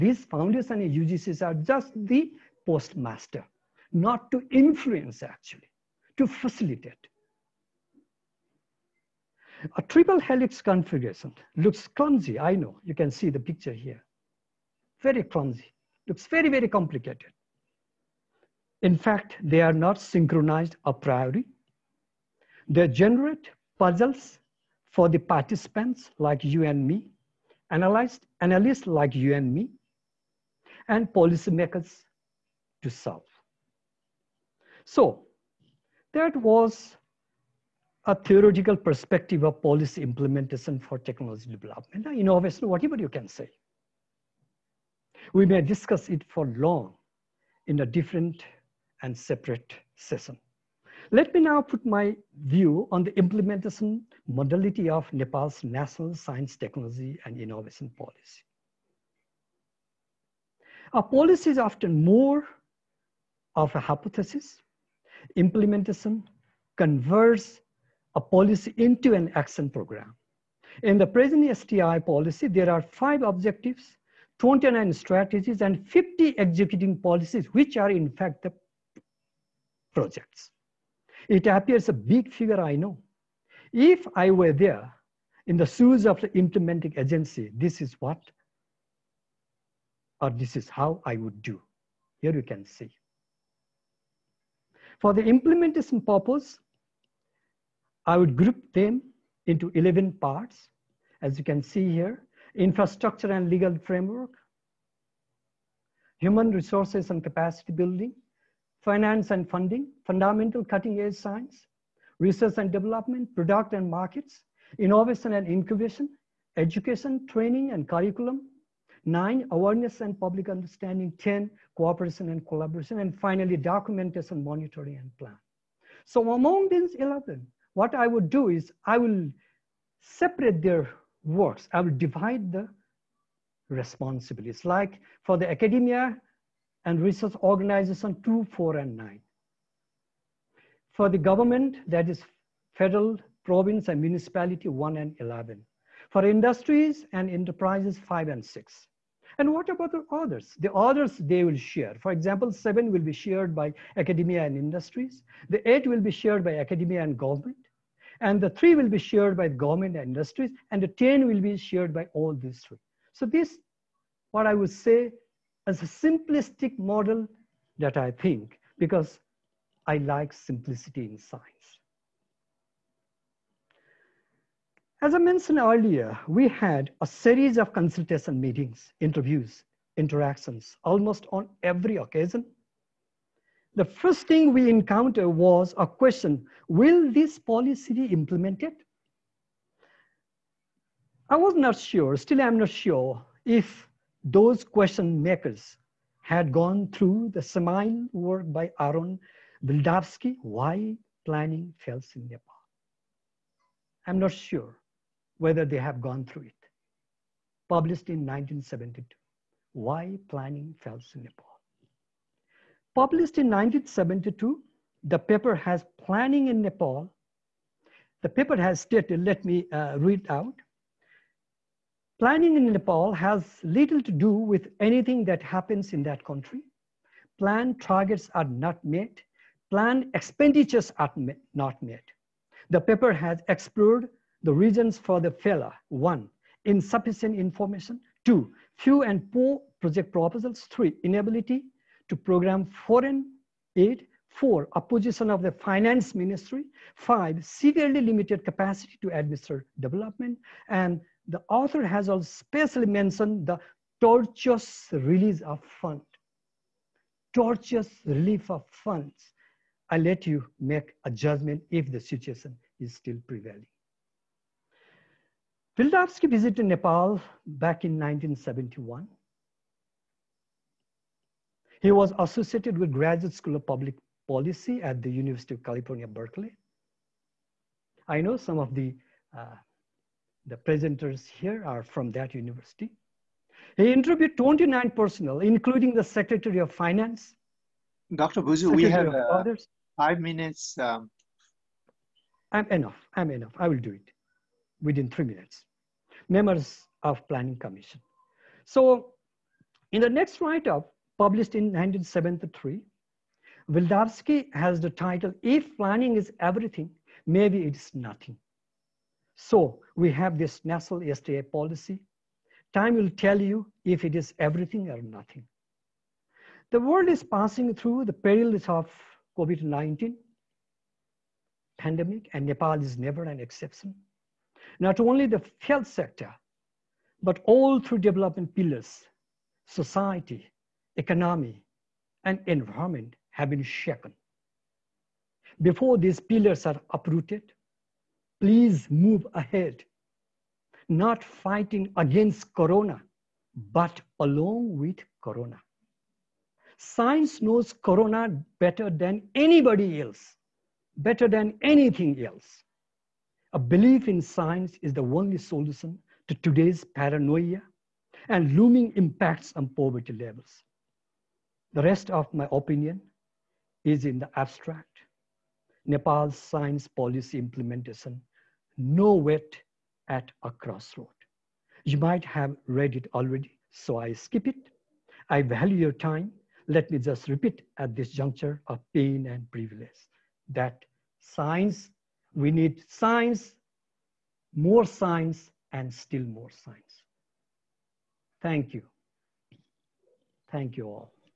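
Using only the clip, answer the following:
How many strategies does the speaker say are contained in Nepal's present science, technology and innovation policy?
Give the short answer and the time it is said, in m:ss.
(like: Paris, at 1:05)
29, at 1:14.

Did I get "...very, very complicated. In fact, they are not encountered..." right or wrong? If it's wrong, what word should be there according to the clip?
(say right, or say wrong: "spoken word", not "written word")
wrong: "synchronized", not "encountered".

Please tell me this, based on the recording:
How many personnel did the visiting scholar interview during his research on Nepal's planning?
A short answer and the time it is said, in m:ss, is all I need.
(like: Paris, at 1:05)
29, at 4:44.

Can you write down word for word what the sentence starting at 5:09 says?
So we have this national SDA policy.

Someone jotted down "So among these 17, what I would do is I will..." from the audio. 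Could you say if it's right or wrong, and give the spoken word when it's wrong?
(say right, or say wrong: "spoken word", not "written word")
wrong: "11", not "17".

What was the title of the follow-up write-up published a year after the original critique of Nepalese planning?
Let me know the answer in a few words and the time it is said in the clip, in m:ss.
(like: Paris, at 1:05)
If Planning is Everything, Maybe It's Nothing, at 5:05.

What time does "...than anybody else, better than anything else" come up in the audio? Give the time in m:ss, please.
5:48.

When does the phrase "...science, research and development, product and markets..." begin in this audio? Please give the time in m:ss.
1:51.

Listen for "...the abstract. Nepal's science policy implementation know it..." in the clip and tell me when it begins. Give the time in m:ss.
6:04.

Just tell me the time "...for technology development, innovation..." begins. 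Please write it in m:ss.
0:40.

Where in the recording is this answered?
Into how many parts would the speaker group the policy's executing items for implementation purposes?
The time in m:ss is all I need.
1:39.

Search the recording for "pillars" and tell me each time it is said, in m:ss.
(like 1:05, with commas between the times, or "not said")
5:28, 5:36.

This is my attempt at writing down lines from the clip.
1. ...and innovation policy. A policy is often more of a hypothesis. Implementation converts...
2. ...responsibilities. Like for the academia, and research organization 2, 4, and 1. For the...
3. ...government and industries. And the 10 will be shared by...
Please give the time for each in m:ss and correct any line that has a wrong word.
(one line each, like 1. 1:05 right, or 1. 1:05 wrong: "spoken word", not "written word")
1. 0:57 right
2. 2:13 wrong: "9", not "1"
3. 2:39 right.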